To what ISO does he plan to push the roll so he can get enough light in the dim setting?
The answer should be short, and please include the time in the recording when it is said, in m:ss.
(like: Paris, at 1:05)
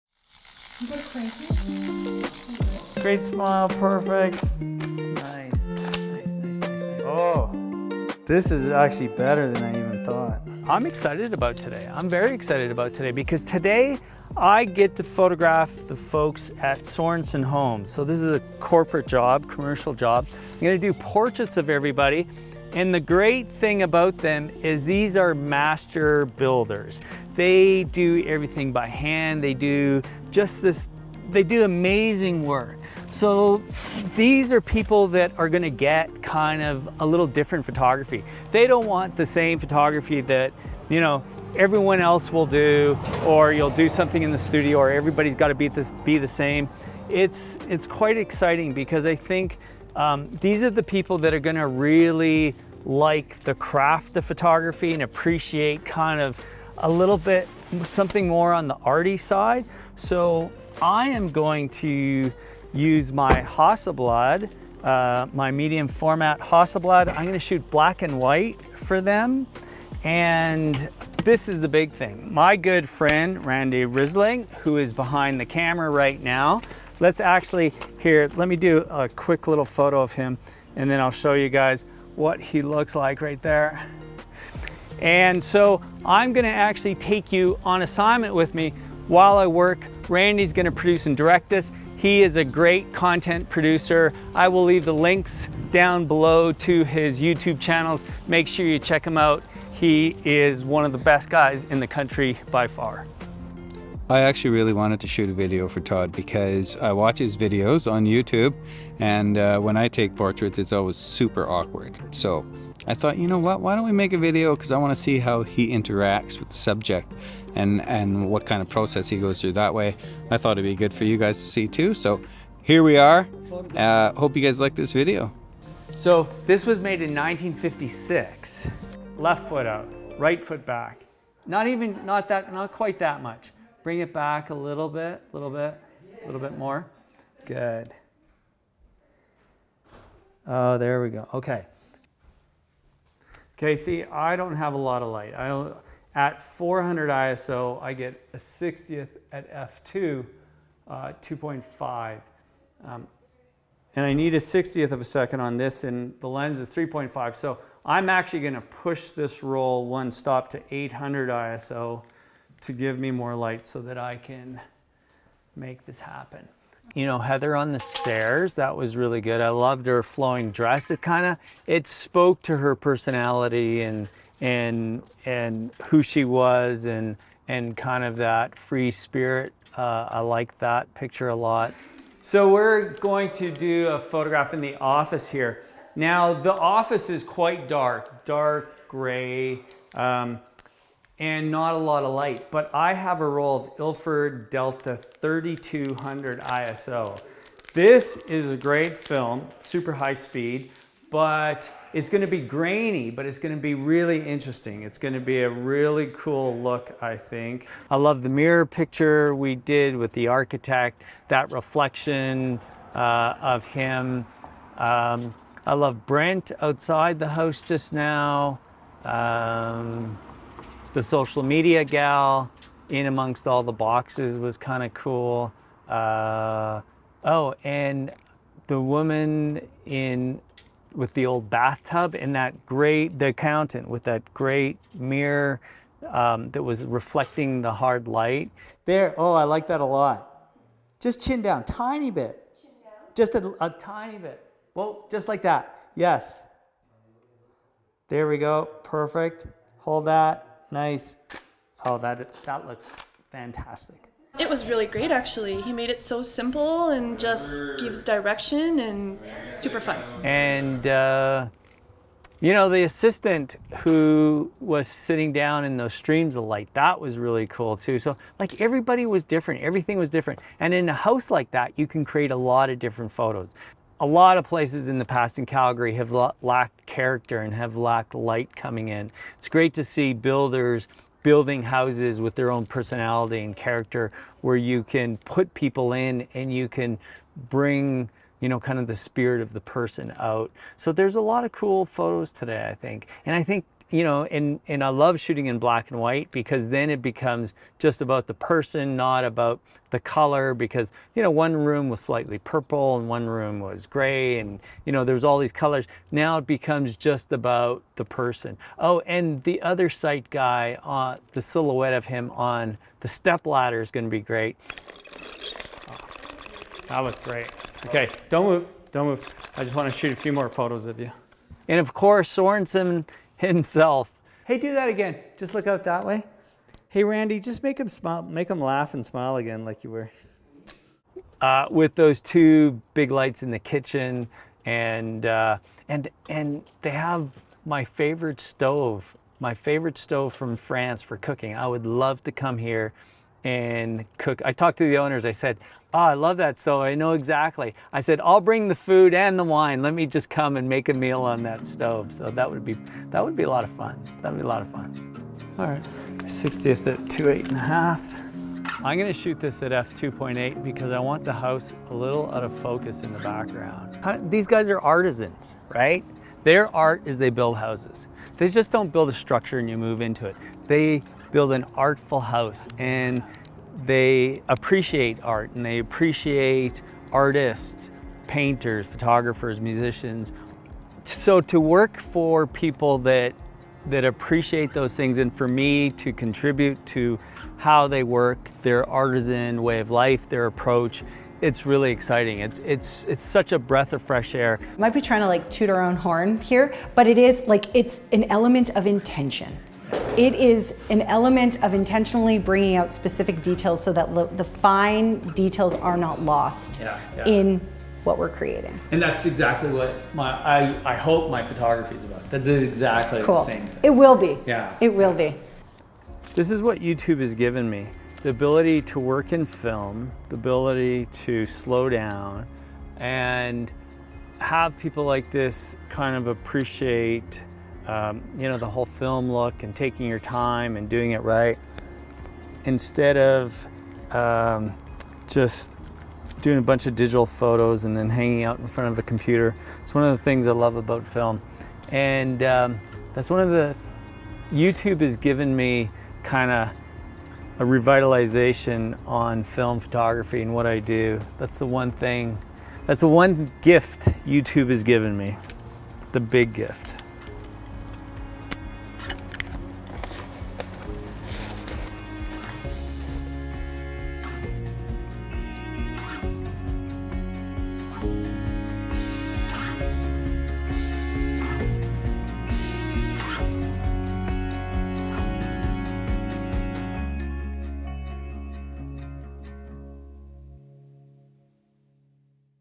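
800, at 2:40.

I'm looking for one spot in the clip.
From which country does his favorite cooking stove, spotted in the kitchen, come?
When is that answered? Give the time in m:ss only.
5:40.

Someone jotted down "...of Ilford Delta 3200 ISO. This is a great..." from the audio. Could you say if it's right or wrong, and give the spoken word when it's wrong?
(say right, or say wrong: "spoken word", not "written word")
right.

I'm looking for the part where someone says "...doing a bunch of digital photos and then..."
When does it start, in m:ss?
7:16.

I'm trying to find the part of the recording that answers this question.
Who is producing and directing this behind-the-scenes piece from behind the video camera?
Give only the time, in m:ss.
1:13.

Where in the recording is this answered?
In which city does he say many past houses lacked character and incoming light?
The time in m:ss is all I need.
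4:35.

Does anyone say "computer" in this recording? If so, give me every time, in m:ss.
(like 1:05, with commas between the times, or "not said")
7:19.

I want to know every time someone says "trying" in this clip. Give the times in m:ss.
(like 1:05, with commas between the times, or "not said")
6:35.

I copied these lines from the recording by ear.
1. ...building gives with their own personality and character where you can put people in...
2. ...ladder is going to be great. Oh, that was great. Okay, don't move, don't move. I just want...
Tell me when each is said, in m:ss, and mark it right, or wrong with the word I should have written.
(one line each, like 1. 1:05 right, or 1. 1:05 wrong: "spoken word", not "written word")
1. 4:41 wrong: "houses", not "gives"
2. 5:13 right.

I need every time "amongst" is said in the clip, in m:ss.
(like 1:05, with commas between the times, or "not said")
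3:43.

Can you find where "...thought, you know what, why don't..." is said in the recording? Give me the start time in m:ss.
1:52.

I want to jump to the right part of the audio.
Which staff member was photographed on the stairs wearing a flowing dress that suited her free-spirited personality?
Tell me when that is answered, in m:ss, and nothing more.
2:47.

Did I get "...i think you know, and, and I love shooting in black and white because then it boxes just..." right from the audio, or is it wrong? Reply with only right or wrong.
wrong.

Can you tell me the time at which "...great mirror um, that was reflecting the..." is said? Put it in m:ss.
3:54.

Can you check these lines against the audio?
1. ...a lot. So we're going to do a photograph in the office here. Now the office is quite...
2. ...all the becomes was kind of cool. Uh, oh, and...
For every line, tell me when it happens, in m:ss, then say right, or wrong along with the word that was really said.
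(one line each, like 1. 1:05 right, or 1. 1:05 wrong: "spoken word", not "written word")
1. 3:01 right
2. 3:43 wrong: "boxes", not "becomes".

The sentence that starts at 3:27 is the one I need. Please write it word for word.
I love the mirror picture we did with the architect, that reflection uh, of him.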